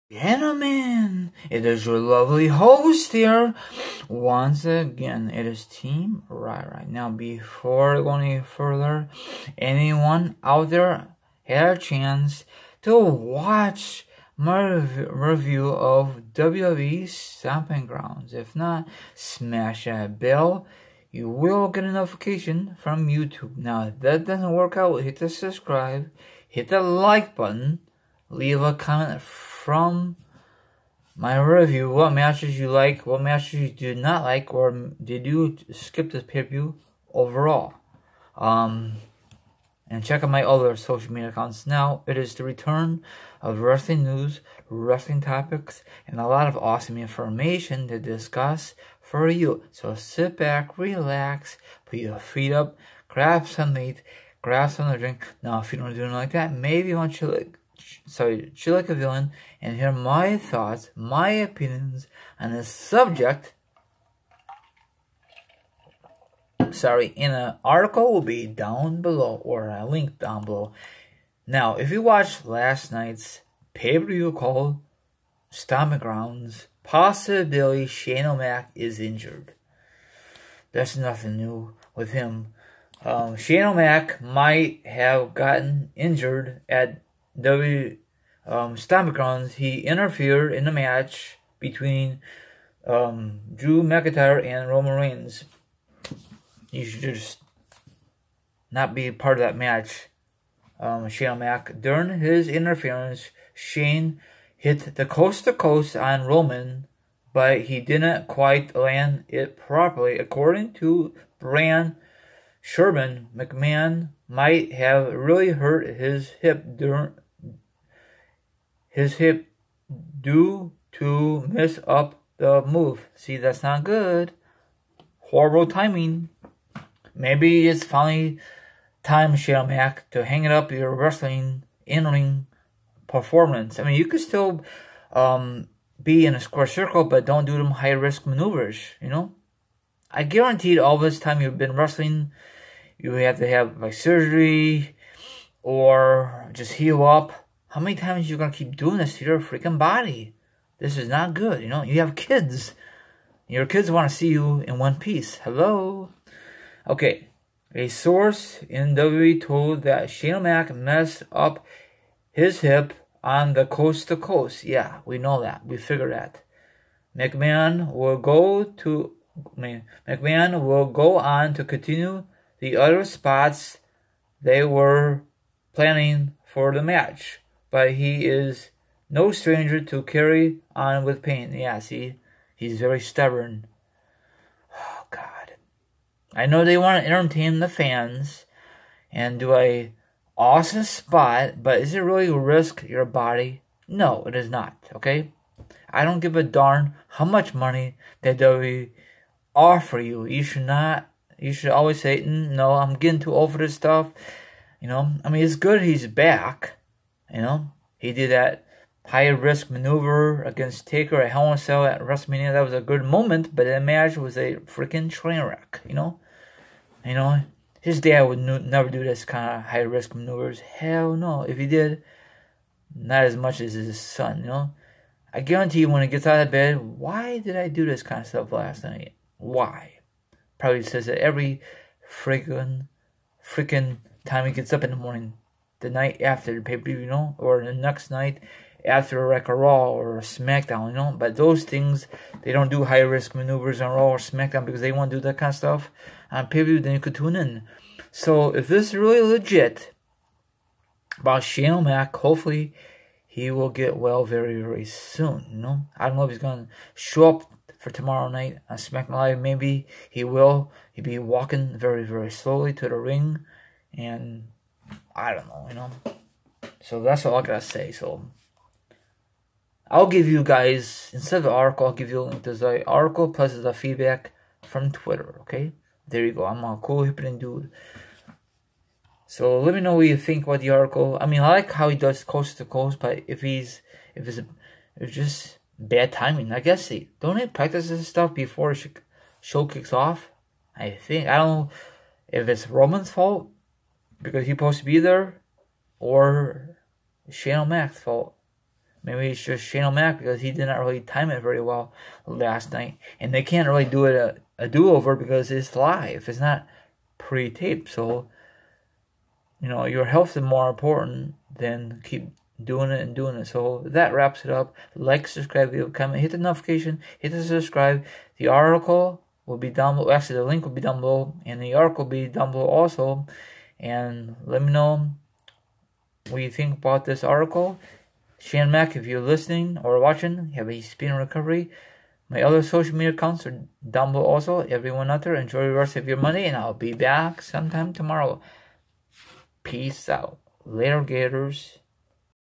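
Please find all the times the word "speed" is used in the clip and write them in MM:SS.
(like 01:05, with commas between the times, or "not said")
05:30.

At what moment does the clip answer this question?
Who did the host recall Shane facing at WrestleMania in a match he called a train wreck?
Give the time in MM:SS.
03:30.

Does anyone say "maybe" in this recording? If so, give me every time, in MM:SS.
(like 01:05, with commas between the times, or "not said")
00:56, 02:07, 04:19, 04:59.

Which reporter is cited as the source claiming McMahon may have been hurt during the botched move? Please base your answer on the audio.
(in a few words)
Brad Shepard.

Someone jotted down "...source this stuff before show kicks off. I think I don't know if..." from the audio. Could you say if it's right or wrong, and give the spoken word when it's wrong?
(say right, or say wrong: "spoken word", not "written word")
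wrong: "practice", not "source".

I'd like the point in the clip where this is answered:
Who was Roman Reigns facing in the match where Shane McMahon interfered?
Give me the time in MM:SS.
01:33.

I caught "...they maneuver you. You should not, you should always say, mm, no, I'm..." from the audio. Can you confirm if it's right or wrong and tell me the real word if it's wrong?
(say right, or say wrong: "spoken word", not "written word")
wrong: "offer", not "maneuver".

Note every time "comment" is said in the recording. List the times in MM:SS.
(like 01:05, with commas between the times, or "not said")
00:28, 05:15.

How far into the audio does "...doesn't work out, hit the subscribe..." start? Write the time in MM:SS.
00:24.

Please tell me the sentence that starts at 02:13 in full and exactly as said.
I mean, you could still um, be in a square circle, but don't do them high-risk maneuvers, you know?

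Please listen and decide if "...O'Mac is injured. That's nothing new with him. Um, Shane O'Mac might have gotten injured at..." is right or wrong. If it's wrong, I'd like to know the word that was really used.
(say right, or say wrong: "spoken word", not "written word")
right.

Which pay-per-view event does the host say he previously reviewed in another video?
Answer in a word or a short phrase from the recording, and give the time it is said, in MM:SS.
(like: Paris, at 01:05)
WWE Stomping Grounds, at 00:16.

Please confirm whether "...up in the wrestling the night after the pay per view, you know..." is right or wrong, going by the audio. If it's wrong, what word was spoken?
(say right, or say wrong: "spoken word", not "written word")
wrong: "morning", not "wrestling".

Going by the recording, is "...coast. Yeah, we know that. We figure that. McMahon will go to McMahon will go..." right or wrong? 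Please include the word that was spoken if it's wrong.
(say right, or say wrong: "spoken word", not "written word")
right.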